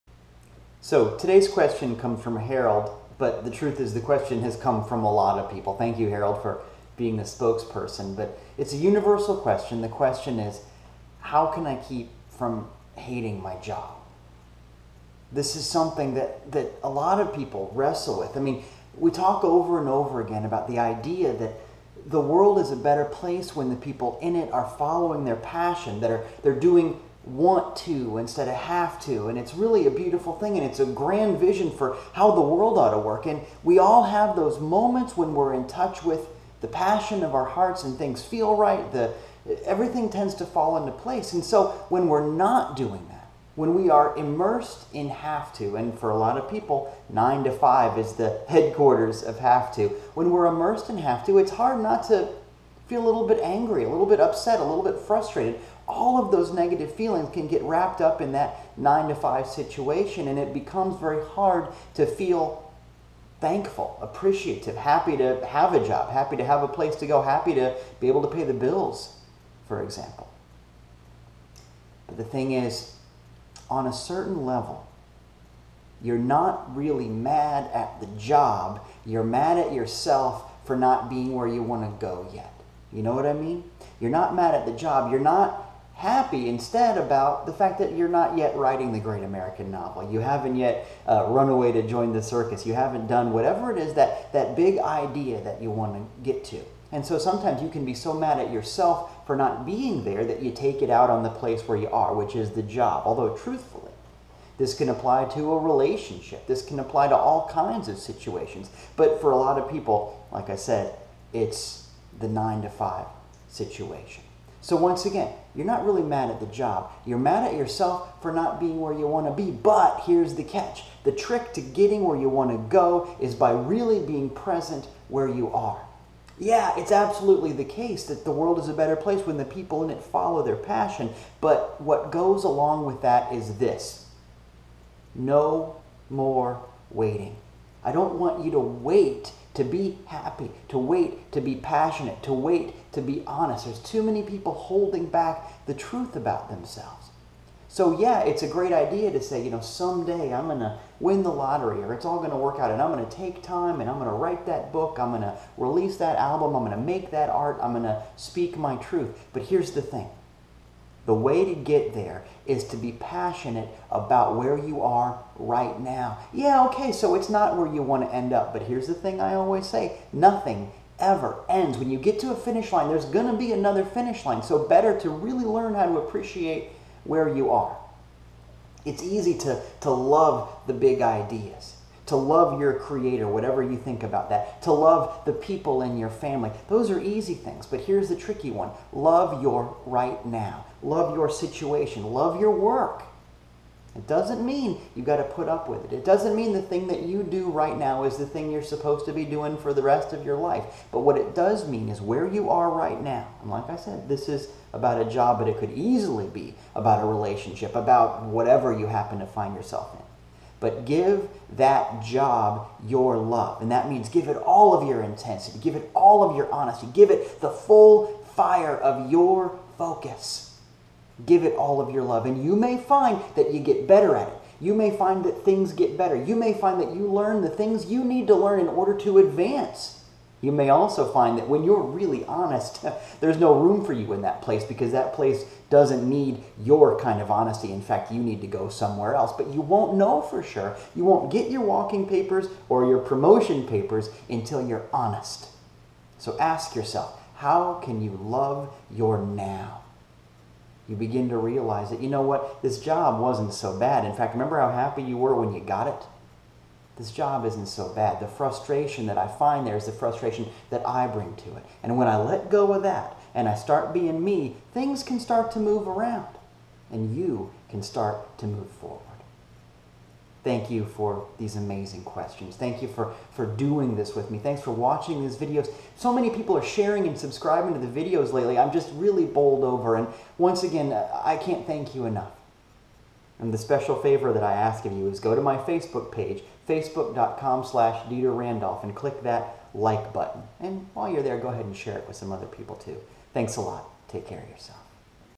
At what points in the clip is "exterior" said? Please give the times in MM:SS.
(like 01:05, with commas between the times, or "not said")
not said.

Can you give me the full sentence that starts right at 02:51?
When you get to a finish line, there's going to be another finish line.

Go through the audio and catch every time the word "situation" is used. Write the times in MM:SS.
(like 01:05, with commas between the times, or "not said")
00:59, 01:47, 01:53, 03:11.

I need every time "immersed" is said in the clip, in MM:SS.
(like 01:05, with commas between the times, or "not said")
00:44, 00:50.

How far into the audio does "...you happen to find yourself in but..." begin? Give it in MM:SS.
03:28.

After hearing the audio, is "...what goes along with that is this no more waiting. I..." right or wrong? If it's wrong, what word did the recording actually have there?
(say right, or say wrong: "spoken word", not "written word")
right.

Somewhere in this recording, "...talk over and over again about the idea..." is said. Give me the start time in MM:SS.
00:19.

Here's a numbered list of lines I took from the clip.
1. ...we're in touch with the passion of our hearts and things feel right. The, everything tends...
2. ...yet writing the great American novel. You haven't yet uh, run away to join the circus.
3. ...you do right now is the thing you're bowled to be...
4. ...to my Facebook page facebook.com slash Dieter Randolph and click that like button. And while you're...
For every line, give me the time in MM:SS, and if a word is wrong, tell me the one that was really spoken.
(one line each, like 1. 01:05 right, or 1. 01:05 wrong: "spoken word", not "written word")
1. 00:35 right
2. 01:28 right
3. 03:17 wrong: "supposed", not "bowled"
4. 04:45 right.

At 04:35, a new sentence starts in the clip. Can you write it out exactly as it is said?
So many people are sharing and subscribing to the videos lately.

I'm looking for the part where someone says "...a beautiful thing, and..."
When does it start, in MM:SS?
00:29.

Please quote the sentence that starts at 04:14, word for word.
In fact, remember how happy you were when you got it?